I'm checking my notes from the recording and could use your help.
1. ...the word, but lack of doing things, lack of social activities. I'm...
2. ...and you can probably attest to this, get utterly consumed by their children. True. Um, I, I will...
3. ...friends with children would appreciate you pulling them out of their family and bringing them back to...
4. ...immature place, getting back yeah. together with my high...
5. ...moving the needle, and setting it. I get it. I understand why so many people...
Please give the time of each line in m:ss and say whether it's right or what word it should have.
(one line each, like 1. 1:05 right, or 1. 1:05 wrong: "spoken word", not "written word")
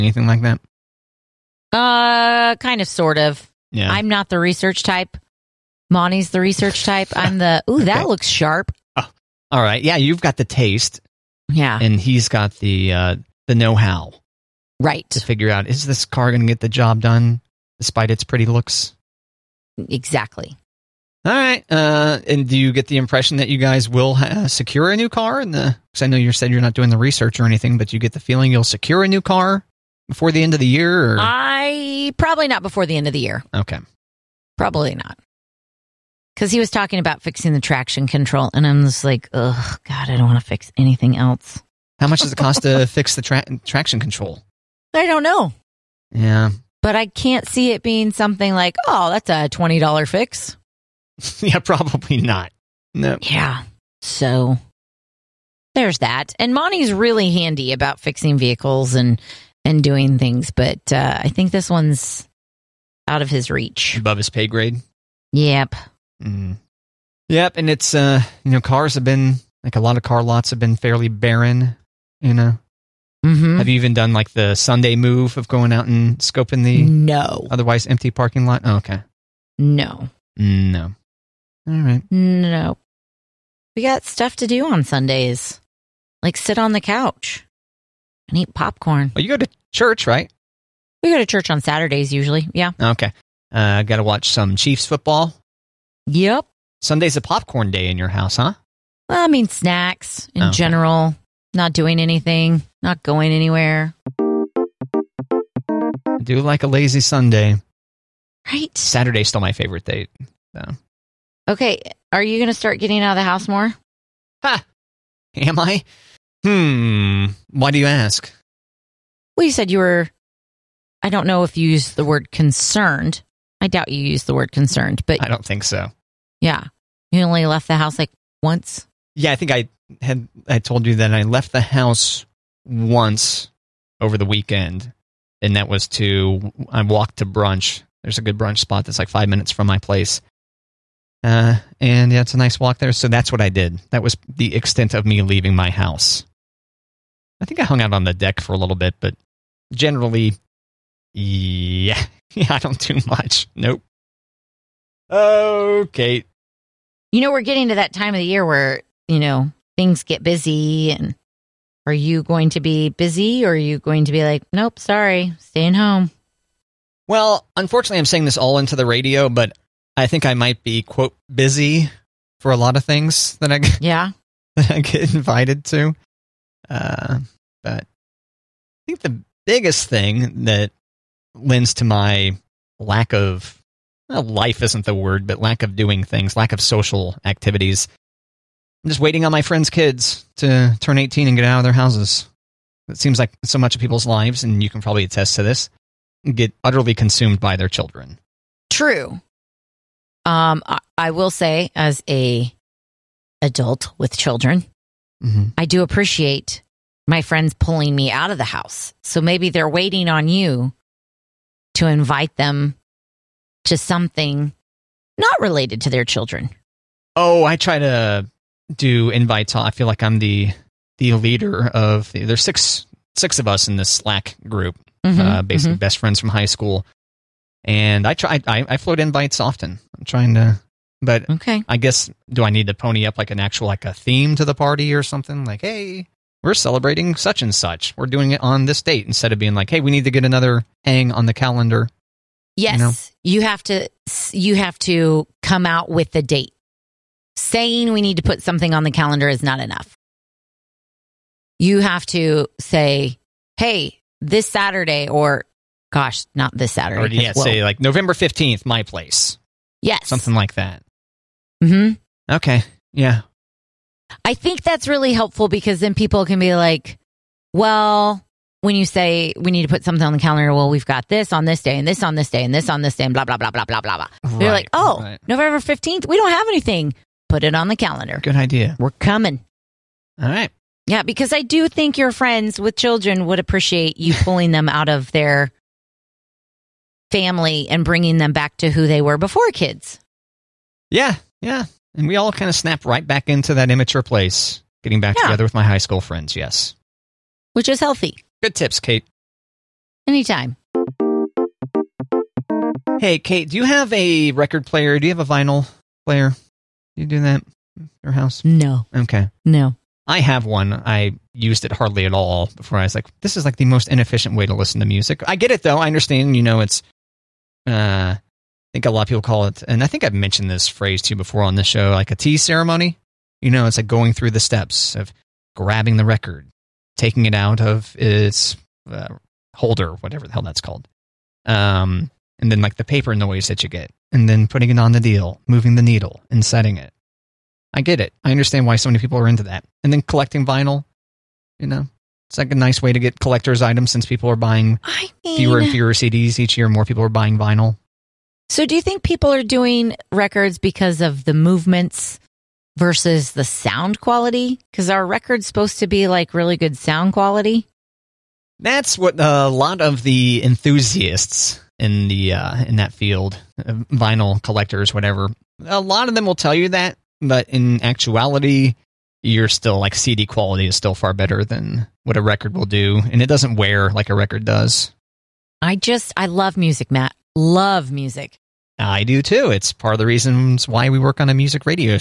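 1. 3:04 right
2. 3:14 right
3. 4:42 right
4. 4:53 right
5. 5:35 right.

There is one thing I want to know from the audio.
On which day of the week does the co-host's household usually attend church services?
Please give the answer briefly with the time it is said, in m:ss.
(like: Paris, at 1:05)
Saturdays, at 1:31.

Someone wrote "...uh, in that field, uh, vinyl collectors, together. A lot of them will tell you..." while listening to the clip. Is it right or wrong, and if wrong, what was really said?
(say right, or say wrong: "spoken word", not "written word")
wrong: "whatever", not "together".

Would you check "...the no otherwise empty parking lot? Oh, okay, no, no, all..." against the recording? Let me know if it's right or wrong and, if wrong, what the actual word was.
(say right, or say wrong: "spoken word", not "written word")
right.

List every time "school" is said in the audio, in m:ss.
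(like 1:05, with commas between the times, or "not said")
3:46, 4:55.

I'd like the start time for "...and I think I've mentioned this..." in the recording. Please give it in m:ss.
5:19.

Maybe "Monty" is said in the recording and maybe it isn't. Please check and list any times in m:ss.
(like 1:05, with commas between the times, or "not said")
0:05, 0:56.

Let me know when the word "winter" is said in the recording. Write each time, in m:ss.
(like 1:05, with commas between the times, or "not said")
not said.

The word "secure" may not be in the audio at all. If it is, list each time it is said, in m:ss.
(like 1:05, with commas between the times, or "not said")
0:24, 0:28.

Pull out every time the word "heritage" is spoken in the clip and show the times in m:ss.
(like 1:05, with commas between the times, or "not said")
not said.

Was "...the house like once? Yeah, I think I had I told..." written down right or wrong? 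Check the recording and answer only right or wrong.
right.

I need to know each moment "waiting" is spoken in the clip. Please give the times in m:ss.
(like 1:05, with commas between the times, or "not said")
3:08, 3:29.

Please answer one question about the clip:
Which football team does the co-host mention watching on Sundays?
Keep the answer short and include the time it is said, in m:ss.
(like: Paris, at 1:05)
Chiefs, at 1:34.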